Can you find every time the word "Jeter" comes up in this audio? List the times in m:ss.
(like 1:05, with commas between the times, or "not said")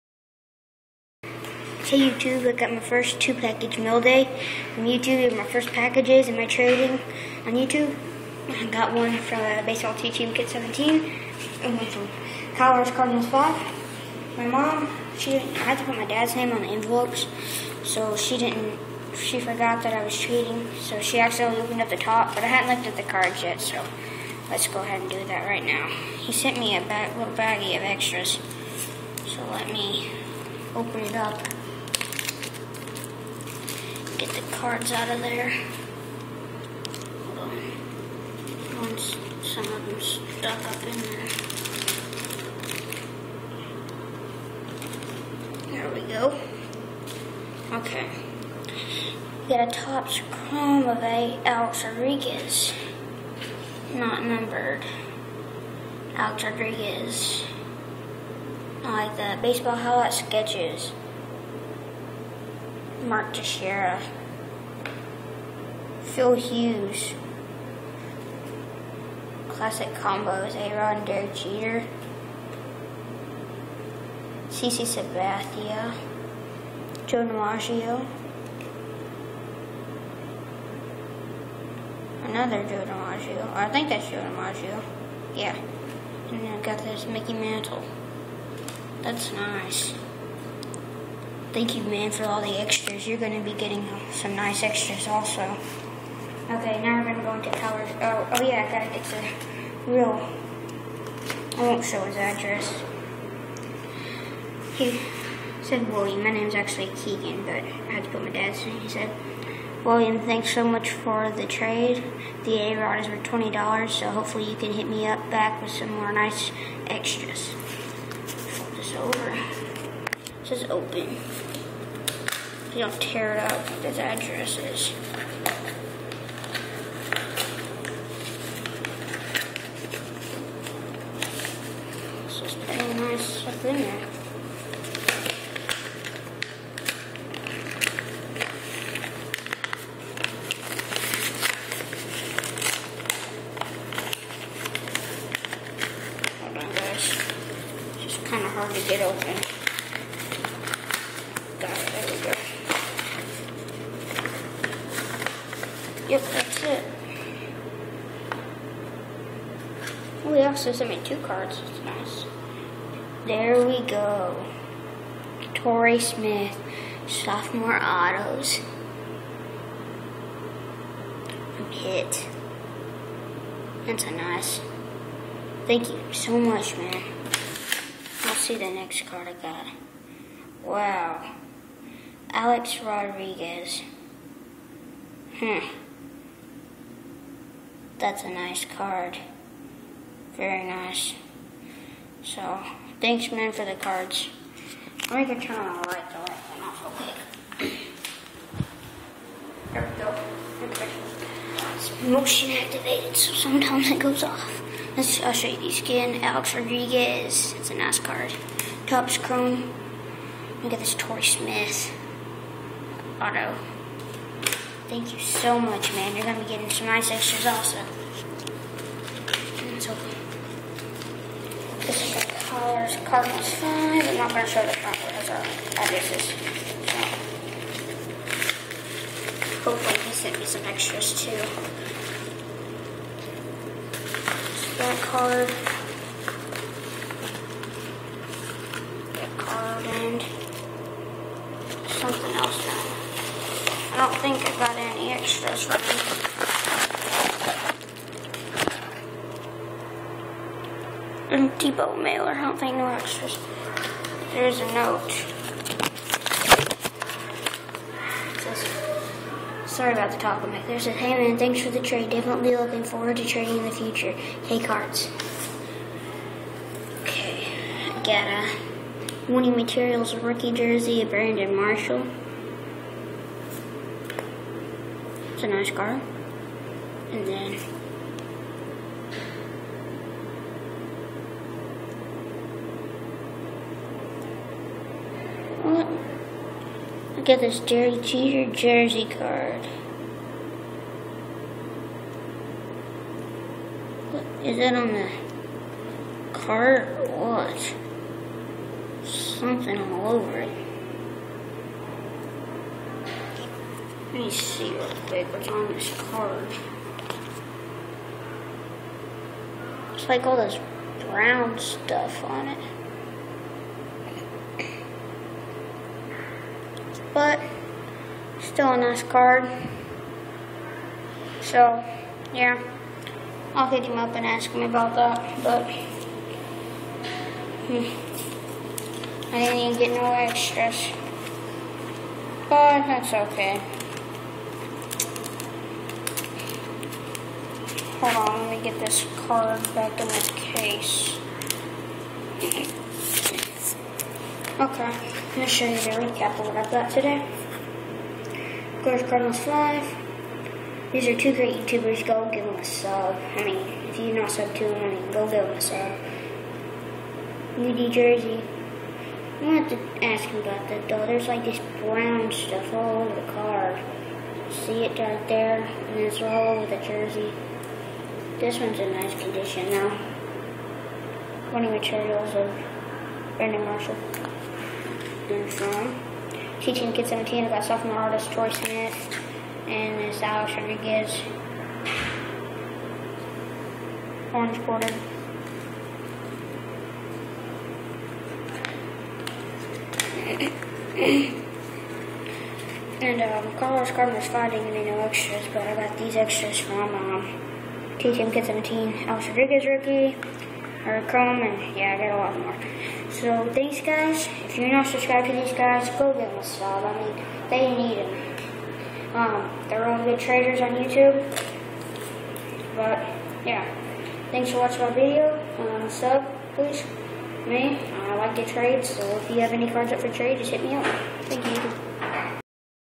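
1:11, 4:48.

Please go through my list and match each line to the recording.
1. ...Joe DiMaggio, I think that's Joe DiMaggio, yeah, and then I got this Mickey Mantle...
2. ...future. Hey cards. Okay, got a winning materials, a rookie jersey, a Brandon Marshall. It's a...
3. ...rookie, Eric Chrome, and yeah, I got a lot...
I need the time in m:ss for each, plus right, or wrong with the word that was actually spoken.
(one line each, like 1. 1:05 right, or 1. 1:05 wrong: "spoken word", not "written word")
1. 1:22 right
2. 4:23 right
3. 6:39 right.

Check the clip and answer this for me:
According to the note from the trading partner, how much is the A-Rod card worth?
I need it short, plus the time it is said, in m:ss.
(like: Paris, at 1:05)
$20, at 1:53.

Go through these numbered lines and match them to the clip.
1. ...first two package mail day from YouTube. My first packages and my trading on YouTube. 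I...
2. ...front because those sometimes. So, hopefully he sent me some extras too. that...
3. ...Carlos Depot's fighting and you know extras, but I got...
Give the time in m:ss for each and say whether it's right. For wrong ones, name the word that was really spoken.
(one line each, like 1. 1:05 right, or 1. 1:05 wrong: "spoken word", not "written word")
1. 0:02 right
2. 3:44 wrong: "addresses", not "sometimes"
3. 6:33 wrong: "Gardner", not "Depot".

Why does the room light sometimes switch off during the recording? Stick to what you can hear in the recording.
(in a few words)
It's motion activated.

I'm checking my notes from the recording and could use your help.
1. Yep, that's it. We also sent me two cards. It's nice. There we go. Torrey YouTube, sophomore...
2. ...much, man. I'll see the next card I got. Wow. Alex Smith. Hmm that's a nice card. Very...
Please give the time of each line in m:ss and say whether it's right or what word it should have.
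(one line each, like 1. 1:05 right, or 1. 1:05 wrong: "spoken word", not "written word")
1. 2:36 wrong: "Smith", not "YouTube"
2. 2:56 wrong: "Rodriguez", not "Smith".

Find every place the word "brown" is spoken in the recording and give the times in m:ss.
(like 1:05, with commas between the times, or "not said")
5:11, 6:01.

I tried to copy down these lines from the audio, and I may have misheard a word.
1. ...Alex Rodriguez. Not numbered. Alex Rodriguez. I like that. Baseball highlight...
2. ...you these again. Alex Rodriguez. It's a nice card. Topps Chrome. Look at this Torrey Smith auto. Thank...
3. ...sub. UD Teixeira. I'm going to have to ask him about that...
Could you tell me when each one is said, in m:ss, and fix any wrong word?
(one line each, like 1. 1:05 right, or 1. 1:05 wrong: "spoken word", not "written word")
1. 0:51 right
2. 3:25 right
3. 5:55 wrong: "Jersey", not "Teixeira".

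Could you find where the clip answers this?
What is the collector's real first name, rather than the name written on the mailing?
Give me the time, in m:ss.
1:46.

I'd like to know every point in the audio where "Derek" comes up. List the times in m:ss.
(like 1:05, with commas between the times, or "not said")
1:11, 4:47.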